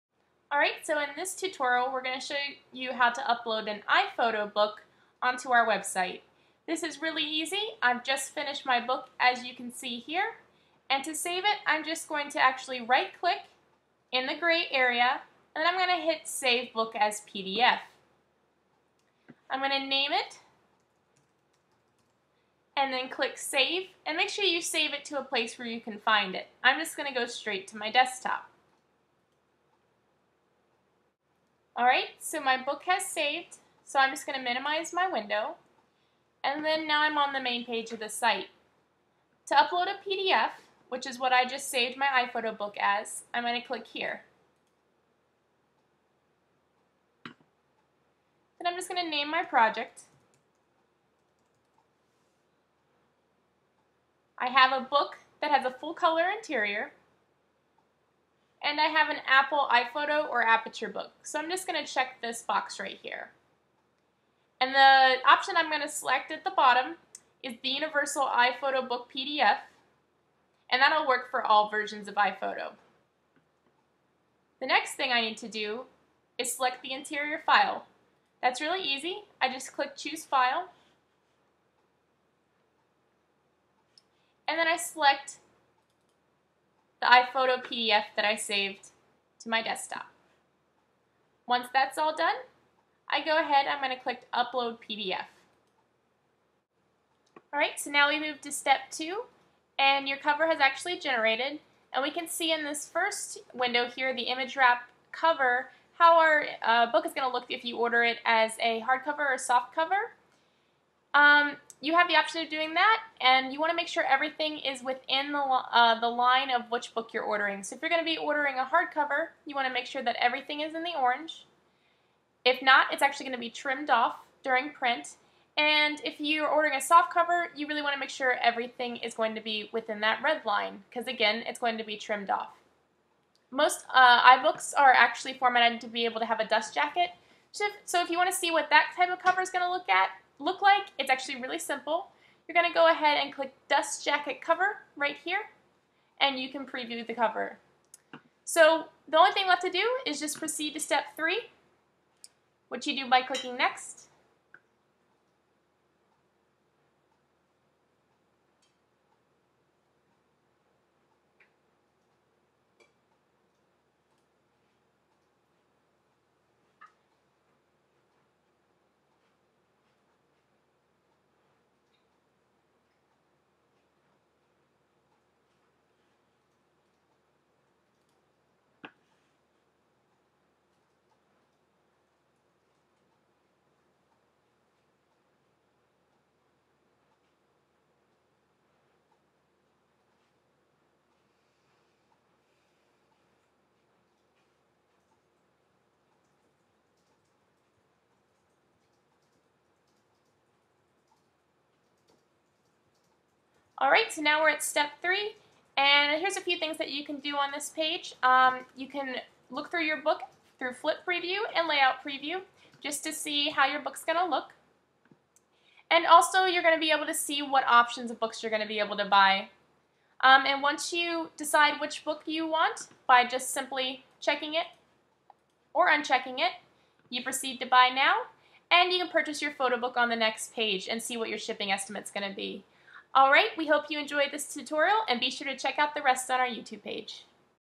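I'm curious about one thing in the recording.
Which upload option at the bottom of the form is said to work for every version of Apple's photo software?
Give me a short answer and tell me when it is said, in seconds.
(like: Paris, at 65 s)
Universal iPhoto Book PDF, at 67 s.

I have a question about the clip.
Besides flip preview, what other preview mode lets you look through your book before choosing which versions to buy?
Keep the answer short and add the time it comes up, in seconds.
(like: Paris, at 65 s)
Layout preview, at 211 s.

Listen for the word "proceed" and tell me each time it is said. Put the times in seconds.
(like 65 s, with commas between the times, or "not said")
150 s, 227 s.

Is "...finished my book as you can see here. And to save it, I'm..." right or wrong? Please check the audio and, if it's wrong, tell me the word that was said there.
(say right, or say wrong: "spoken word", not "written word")
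right.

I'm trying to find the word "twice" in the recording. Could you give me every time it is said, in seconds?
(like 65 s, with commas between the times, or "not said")
not said.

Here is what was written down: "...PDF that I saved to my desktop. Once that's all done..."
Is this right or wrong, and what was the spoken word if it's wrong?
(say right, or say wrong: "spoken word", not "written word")
right.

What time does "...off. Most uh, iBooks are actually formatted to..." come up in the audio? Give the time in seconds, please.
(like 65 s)
132 s.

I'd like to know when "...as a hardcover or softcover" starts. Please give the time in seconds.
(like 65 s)
108 s.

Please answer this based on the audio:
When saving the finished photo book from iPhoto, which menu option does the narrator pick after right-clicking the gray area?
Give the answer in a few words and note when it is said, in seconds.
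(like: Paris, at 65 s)
Save Book as PDF, at 16 s.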